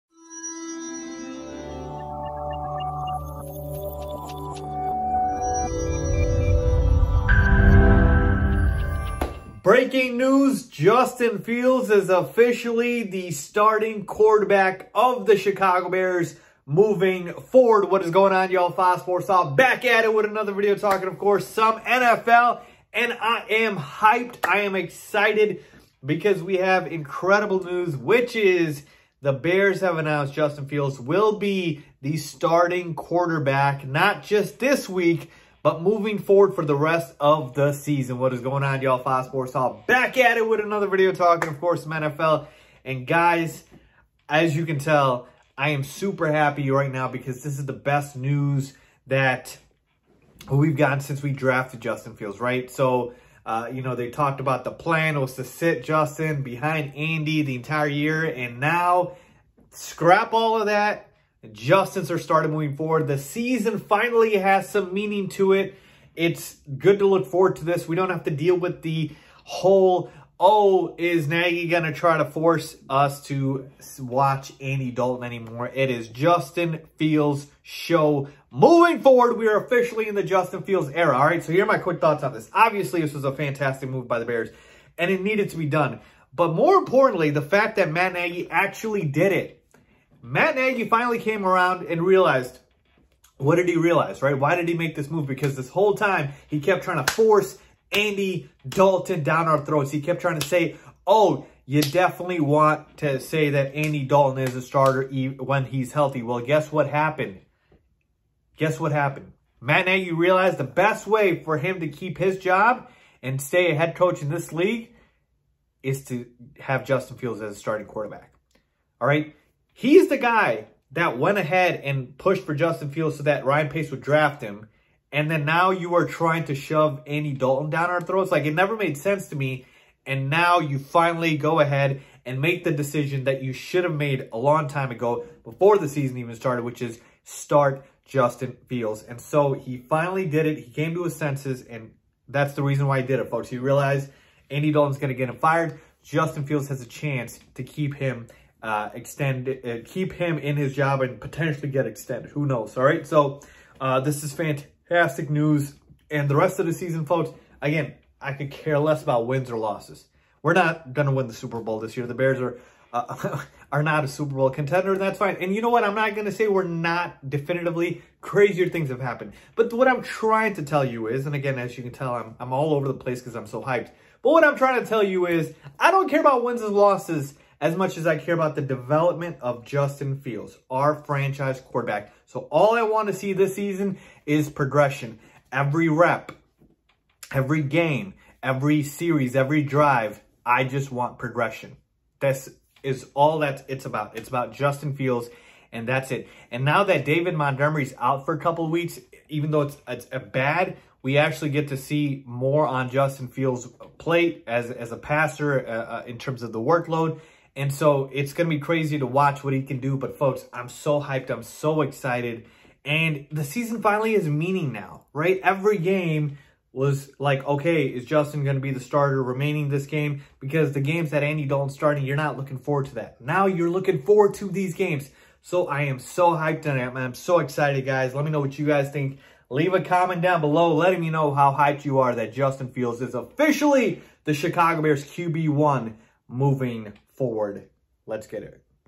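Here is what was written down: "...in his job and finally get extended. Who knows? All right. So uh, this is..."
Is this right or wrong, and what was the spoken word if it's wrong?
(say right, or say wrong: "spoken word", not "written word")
wrong: "potentially", not "finally".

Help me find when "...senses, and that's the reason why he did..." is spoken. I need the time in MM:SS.
02:21.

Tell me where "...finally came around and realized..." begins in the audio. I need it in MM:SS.
01:30.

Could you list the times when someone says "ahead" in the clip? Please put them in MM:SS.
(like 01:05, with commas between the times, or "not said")
02:01, 02:11.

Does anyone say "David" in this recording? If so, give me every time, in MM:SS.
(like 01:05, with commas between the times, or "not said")
03:17.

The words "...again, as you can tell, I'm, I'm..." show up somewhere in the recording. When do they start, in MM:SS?
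02:51.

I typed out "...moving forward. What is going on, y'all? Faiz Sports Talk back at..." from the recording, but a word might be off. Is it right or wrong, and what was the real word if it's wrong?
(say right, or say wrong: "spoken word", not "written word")
right.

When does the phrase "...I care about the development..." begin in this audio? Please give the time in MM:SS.
02:58.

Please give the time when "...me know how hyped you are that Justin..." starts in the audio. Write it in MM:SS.
03:51.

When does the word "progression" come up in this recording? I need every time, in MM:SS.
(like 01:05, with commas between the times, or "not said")
03:04, 03:11.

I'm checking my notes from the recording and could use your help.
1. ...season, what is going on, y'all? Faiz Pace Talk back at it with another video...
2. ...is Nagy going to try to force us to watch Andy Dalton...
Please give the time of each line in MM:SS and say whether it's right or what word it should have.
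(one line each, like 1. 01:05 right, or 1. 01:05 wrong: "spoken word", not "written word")
1. 00:37 wrong: "Sports", not "Pace"
2. 01:10 right.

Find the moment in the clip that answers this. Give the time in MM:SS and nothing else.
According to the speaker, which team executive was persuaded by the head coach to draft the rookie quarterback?
02:03.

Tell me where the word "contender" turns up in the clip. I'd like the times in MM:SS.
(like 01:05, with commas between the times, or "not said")
02:44.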